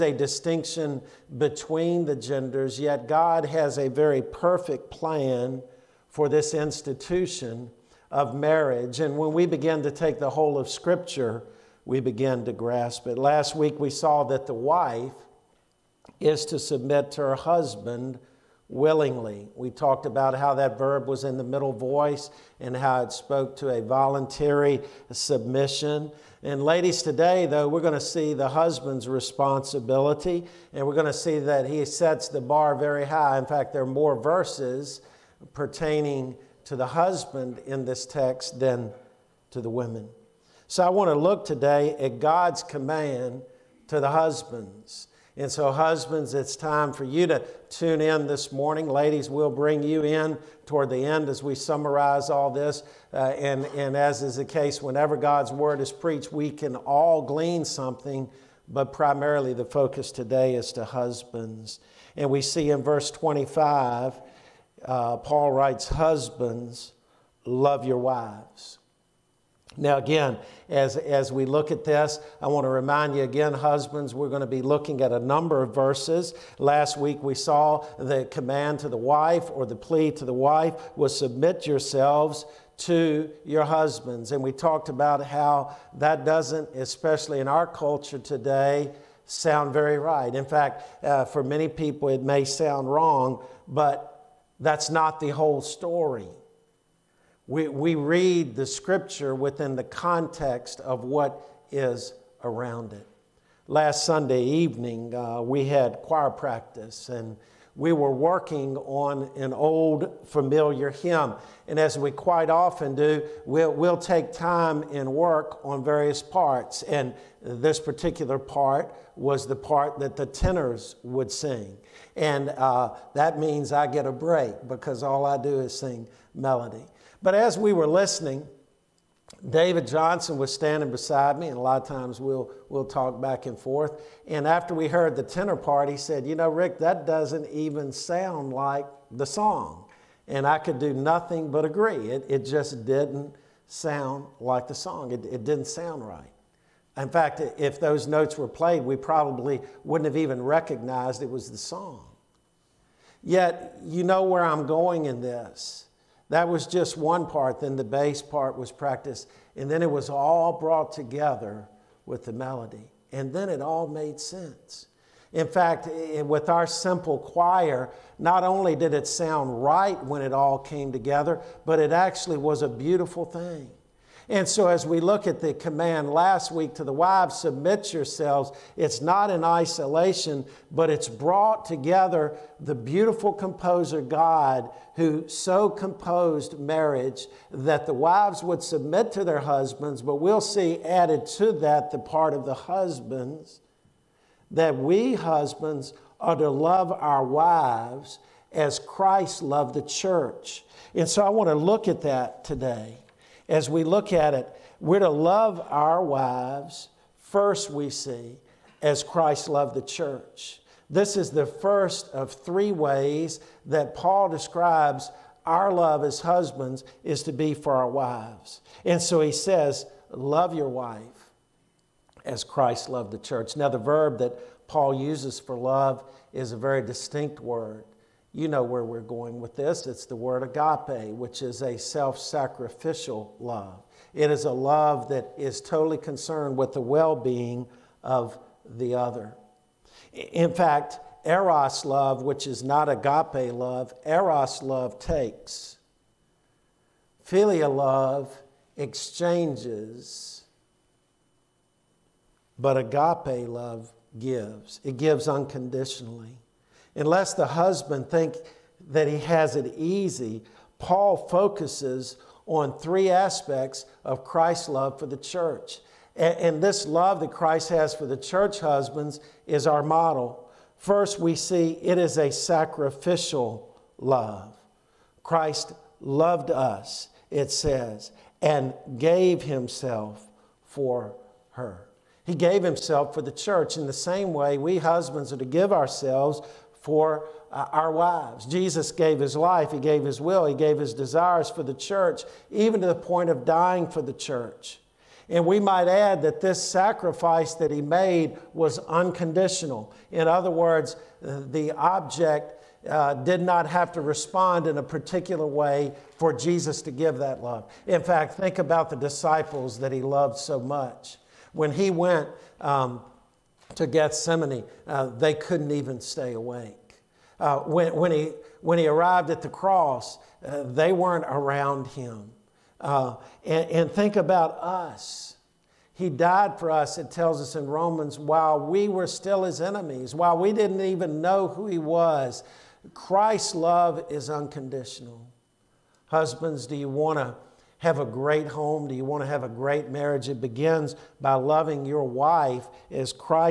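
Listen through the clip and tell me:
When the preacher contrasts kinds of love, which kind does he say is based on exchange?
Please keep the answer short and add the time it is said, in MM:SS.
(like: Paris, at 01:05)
Philia, at 04:07.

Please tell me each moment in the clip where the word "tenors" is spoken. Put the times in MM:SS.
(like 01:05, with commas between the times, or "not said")
02:00, 02:15.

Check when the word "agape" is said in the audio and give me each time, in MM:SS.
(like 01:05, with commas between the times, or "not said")
03:50, 04:02, 04:12.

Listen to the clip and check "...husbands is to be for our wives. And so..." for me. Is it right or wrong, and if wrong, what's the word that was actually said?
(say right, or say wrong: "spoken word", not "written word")
right.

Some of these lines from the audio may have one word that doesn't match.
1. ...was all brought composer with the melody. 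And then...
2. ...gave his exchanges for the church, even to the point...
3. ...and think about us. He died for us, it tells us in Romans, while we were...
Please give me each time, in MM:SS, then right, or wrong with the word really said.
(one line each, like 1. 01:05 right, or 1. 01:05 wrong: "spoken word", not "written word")
1. 02:39 wrong: "together", not "composer"
2. 04:50 wrong: "desires", not "exchanges"
3. 05:23 right.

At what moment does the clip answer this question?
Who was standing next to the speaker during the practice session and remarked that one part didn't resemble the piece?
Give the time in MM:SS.
02:09.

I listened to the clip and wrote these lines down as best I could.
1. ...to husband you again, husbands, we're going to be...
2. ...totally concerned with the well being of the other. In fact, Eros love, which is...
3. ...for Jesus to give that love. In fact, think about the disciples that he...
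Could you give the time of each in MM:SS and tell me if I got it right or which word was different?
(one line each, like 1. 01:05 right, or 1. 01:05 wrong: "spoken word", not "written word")
1. 01:12 wrong: "remind", not "husband"
2. 03:55 right
3. 05:06 right.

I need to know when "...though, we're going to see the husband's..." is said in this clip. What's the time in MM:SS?
00:27.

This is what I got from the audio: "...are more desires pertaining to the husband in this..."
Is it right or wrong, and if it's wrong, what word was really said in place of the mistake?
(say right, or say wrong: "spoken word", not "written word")
wrong: "verses", not "desires".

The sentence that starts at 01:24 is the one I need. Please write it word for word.
And we talked about how that doesn't, especially in our culture today, sound very right.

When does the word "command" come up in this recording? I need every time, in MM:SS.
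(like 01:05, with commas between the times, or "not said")
00:42, 01:18, 02:55.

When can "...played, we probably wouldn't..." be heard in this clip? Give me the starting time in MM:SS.
02:28.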